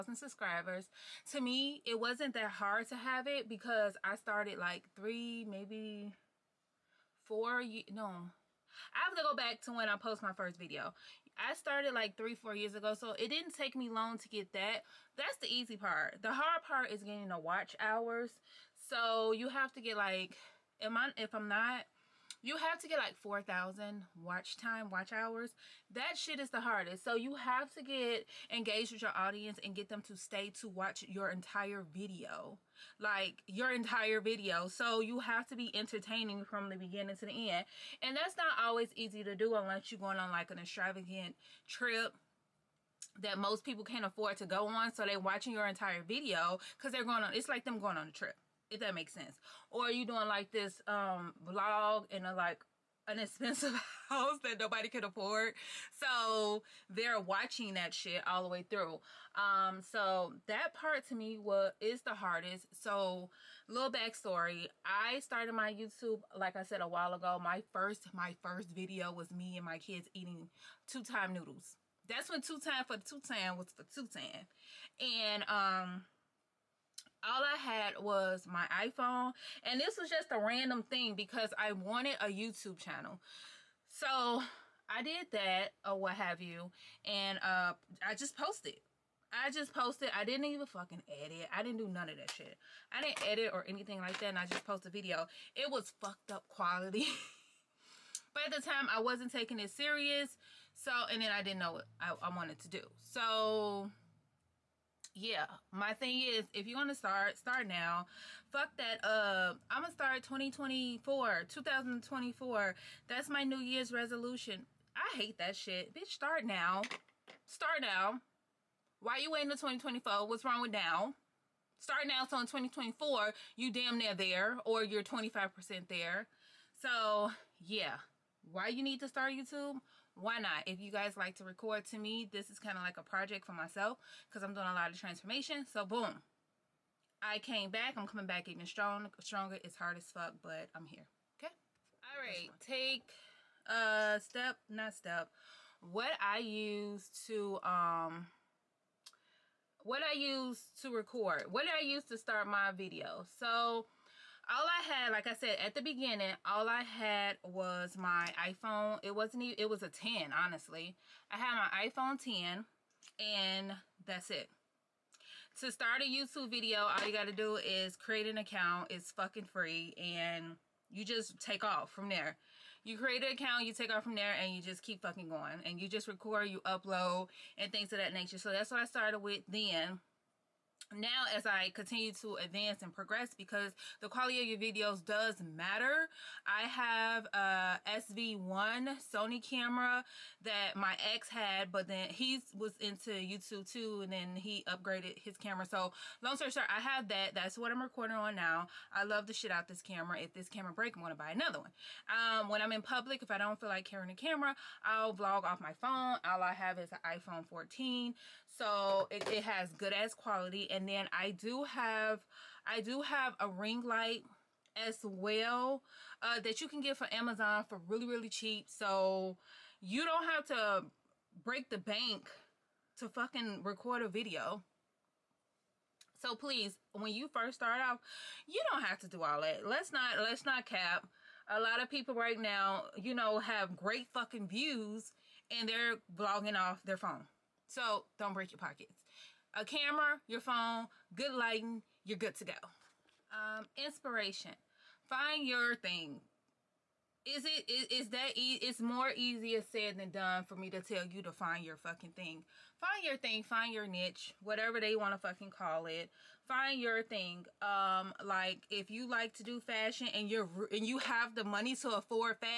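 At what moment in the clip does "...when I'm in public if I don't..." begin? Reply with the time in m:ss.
3:22.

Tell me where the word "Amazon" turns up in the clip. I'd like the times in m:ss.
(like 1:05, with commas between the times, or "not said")
3:37.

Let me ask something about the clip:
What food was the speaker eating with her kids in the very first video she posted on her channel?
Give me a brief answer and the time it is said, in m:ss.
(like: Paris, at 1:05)
two time noodles, at 1:10.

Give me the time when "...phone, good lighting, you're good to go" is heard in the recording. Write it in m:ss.
4:00.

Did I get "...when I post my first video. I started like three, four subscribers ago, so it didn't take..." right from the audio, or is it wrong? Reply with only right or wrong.
wrong.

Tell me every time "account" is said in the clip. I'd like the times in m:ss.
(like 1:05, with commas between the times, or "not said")
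2:48, 2:53.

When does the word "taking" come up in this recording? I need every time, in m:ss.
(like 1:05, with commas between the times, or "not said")
1:39.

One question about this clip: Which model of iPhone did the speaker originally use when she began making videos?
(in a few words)
iPhone 10.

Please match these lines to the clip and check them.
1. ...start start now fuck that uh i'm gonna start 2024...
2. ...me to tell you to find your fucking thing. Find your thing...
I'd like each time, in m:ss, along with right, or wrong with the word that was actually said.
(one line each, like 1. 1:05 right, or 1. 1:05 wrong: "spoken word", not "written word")
1. 1:46 right
2. 4:10 right.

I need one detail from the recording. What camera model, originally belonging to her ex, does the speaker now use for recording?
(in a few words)
ZV1 Sony.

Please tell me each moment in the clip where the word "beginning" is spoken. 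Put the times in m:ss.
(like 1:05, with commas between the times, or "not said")
0:36, 2:35.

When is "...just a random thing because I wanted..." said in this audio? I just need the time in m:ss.
1:20.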